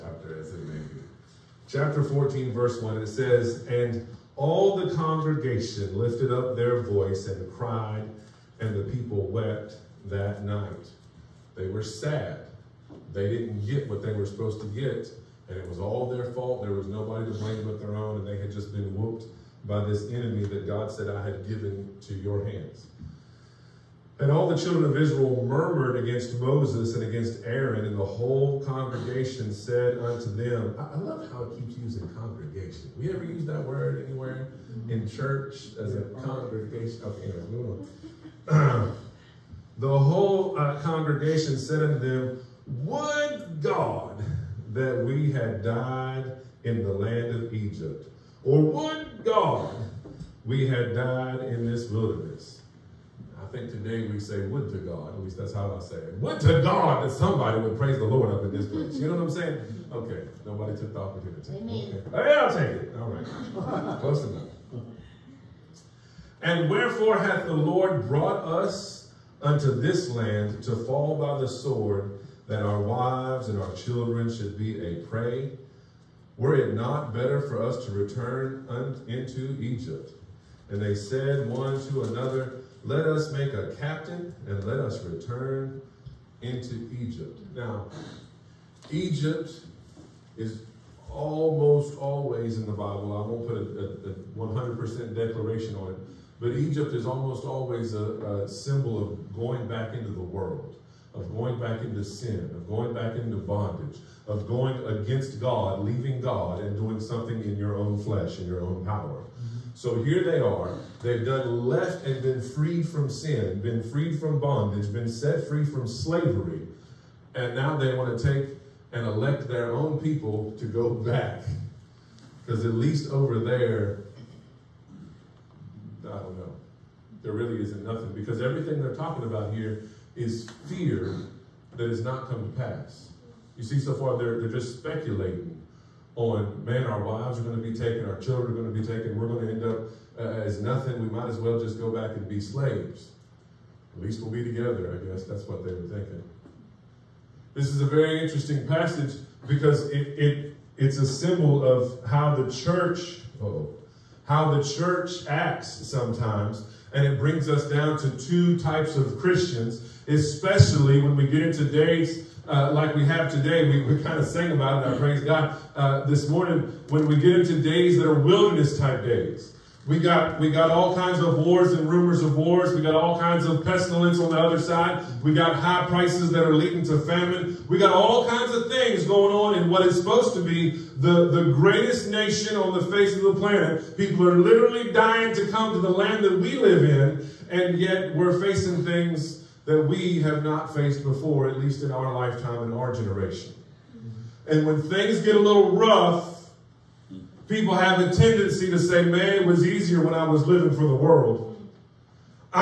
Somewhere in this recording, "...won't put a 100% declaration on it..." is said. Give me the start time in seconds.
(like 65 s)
93 s.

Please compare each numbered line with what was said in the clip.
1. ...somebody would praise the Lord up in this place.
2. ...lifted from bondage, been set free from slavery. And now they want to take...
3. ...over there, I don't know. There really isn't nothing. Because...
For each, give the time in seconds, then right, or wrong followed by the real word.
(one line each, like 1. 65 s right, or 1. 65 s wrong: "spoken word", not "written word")
1. 57 s right
2. 113 s wrong: "freed", not "lifted"
3. 123 s right.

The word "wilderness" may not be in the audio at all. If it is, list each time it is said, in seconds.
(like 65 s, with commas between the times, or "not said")
51 s, 168 s.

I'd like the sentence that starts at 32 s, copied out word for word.
We ever use that word anywhere in church as a congregation?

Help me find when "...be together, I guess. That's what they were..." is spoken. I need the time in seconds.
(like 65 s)
144 s.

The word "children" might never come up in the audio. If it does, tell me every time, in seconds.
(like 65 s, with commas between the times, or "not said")
24 s, 73 s, 138 s.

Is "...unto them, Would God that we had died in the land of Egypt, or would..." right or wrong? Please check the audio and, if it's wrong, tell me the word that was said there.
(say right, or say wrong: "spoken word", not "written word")
right.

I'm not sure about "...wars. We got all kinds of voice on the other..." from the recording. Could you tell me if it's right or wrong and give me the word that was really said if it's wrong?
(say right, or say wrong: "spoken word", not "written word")
wrong: "pestilence", not "voice".